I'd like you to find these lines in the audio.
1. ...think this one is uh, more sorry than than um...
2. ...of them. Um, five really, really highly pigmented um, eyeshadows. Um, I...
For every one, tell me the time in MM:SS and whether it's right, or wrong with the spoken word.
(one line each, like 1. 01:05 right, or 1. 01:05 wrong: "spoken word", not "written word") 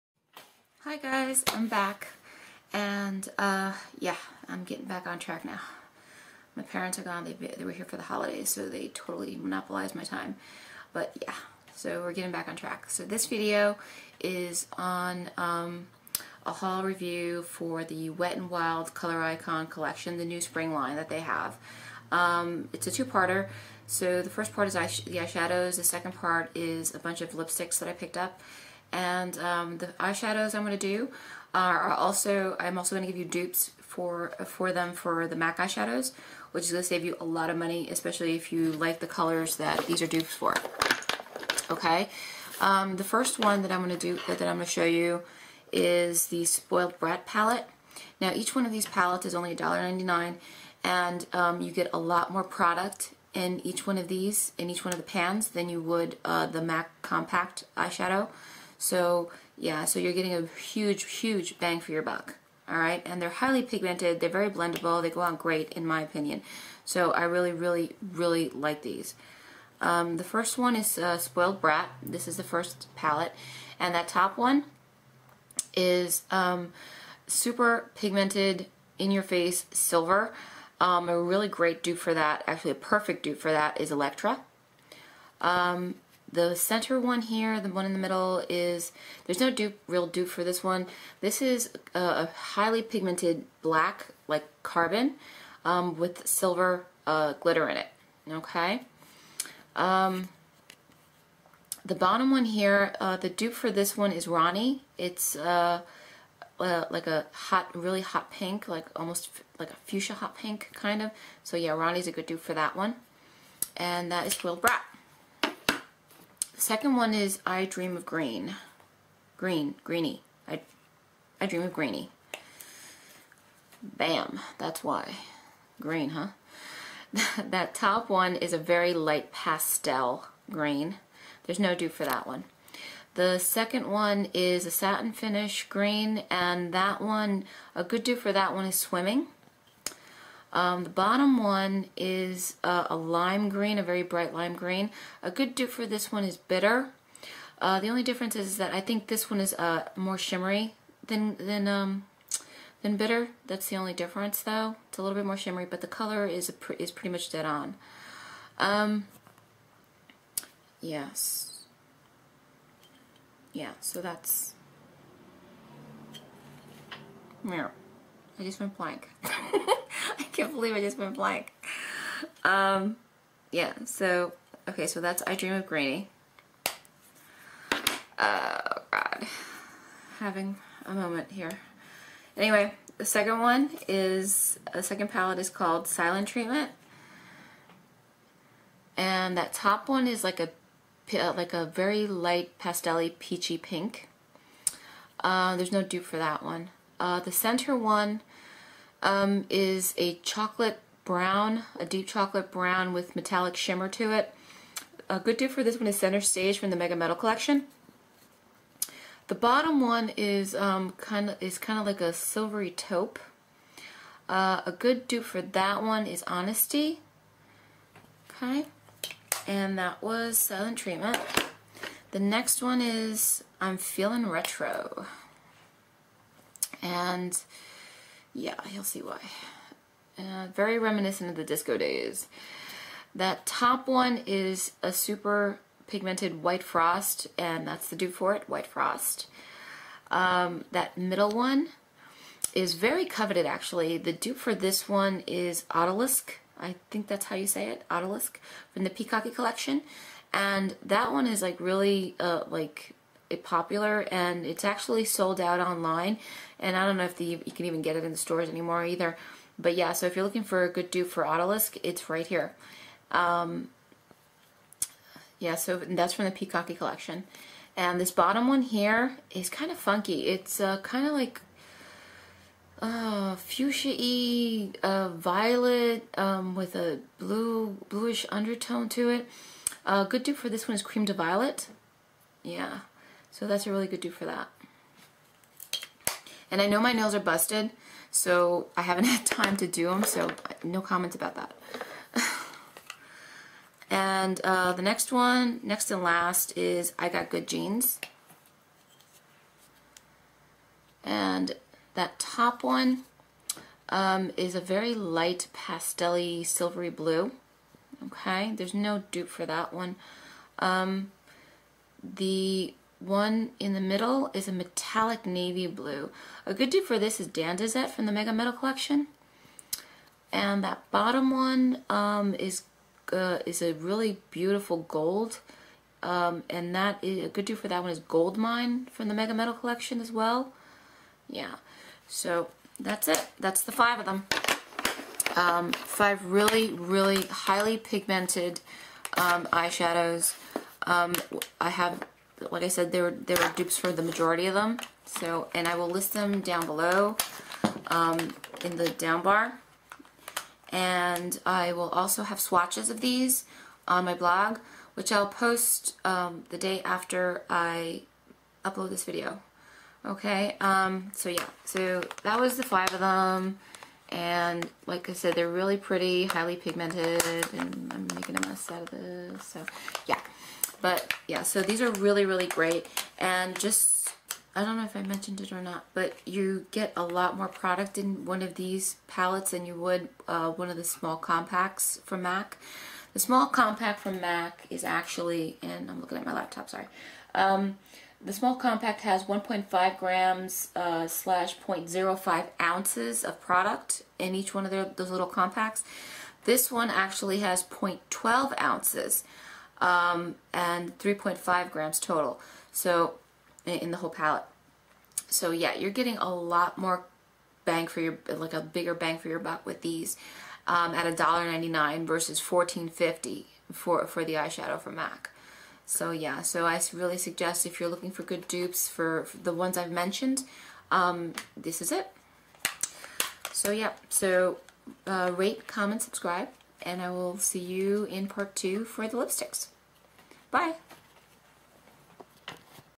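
1. 02:28 wrong: "shimmery", not "sorry"
2. 05:33 right.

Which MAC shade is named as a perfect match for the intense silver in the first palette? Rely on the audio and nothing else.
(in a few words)
Electra.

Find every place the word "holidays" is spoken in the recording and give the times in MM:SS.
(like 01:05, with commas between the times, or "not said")
00:08.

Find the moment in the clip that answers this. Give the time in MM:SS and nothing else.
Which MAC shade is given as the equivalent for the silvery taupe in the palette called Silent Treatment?
03:36.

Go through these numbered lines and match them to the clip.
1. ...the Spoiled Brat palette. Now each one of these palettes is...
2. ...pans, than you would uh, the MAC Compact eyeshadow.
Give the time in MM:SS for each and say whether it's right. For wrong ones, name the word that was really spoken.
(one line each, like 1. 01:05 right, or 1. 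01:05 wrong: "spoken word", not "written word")
1. 00:46 right
2. 00:55 right.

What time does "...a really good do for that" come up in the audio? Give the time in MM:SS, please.
04:43.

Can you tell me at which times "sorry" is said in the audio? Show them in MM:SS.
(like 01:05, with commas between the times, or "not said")
06:26.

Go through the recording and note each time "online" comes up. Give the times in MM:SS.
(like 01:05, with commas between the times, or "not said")
04:15.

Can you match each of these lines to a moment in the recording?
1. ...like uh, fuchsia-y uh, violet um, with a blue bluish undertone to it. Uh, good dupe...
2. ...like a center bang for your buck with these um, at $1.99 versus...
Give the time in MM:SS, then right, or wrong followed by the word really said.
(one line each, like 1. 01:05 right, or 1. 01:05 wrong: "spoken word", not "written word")
1. 04:31 right
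2. 06:48 wrong: "bigger", not "center".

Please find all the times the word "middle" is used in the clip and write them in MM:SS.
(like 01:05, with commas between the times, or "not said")
01:27, 04:00, 05:13.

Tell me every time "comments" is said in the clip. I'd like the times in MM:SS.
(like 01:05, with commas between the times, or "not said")
04:50, 07:05.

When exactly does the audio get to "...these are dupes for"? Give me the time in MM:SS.
00:39.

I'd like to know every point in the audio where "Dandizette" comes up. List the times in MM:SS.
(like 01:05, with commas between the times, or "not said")
05:17.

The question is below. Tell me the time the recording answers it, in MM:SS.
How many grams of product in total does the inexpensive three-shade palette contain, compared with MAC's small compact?
06:40.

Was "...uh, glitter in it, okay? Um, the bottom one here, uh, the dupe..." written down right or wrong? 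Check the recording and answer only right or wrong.
right.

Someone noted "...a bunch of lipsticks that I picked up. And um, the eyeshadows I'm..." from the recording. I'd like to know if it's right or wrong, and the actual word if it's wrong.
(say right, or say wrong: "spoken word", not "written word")
right.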